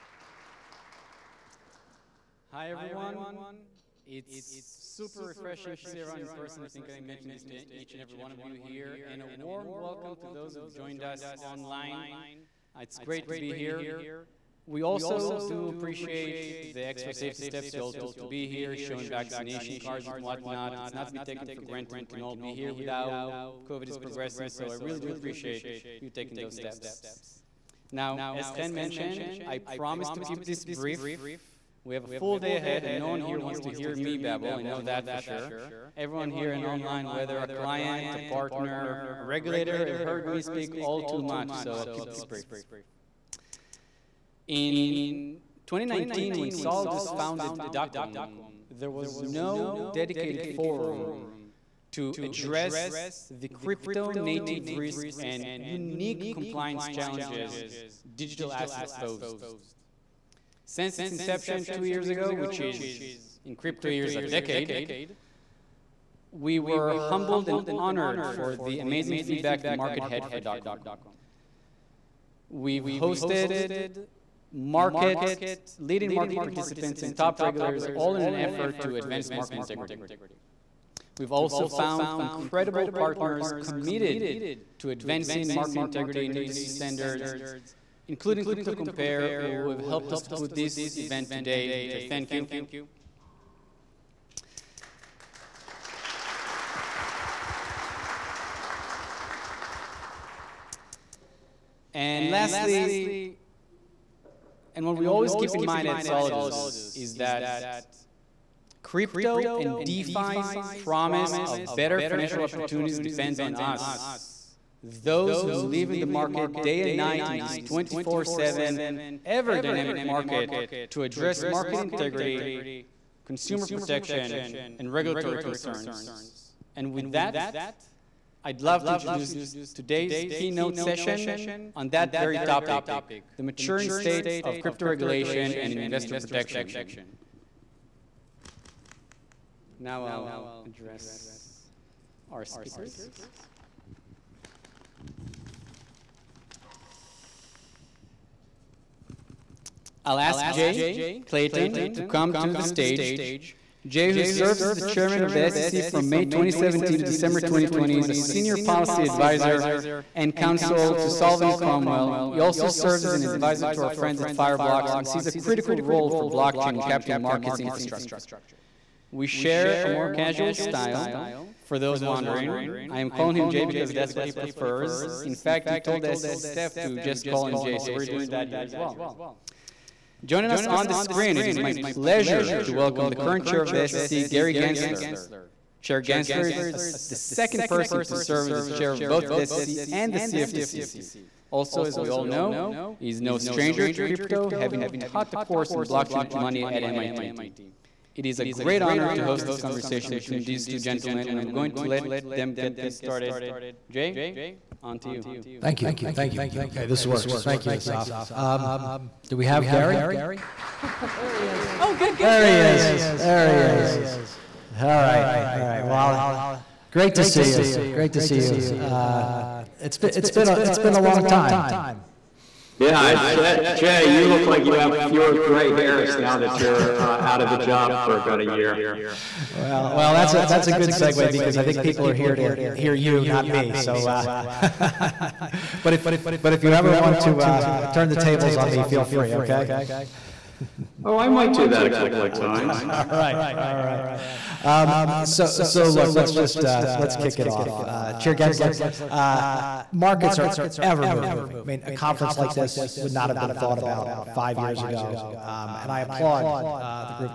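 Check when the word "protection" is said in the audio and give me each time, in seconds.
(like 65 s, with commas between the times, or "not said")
123 s, 136 s.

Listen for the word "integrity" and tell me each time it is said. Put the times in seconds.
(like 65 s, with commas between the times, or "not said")
79 s, 85 s, 121 s.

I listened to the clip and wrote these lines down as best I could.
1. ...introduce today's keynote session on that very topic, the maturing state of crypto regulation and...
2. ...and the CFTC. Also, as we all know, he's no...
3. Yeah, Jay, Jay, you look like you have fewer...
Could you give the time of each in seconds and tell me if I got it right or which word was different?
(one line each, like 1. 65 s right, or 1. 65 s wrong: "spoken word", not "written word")
1. 128 s right
2. 189 s right
3. 222 s right.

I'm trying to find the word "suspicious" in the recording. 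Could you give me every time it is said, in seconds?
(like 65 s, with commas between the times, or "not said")
not said.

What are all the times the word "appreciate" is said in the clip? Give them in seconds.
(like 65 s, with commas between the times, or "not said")
15 s, 25 s.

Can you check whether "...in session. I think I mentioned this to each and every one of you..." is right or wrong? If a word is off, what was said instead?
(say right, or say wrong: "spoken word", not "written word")
wrong: "person", not "session".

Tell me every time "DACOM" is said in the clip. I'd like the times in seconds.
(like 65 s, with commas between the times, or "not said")
47 s, 70 s.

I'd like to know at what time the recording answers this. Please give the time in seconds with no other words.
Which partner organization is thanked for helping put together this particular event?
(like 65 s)
88 s.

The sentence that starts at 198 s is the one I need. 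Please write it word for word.
It is a great honor to host this conversation between these two gentlemen, and I'm going to let them get this started.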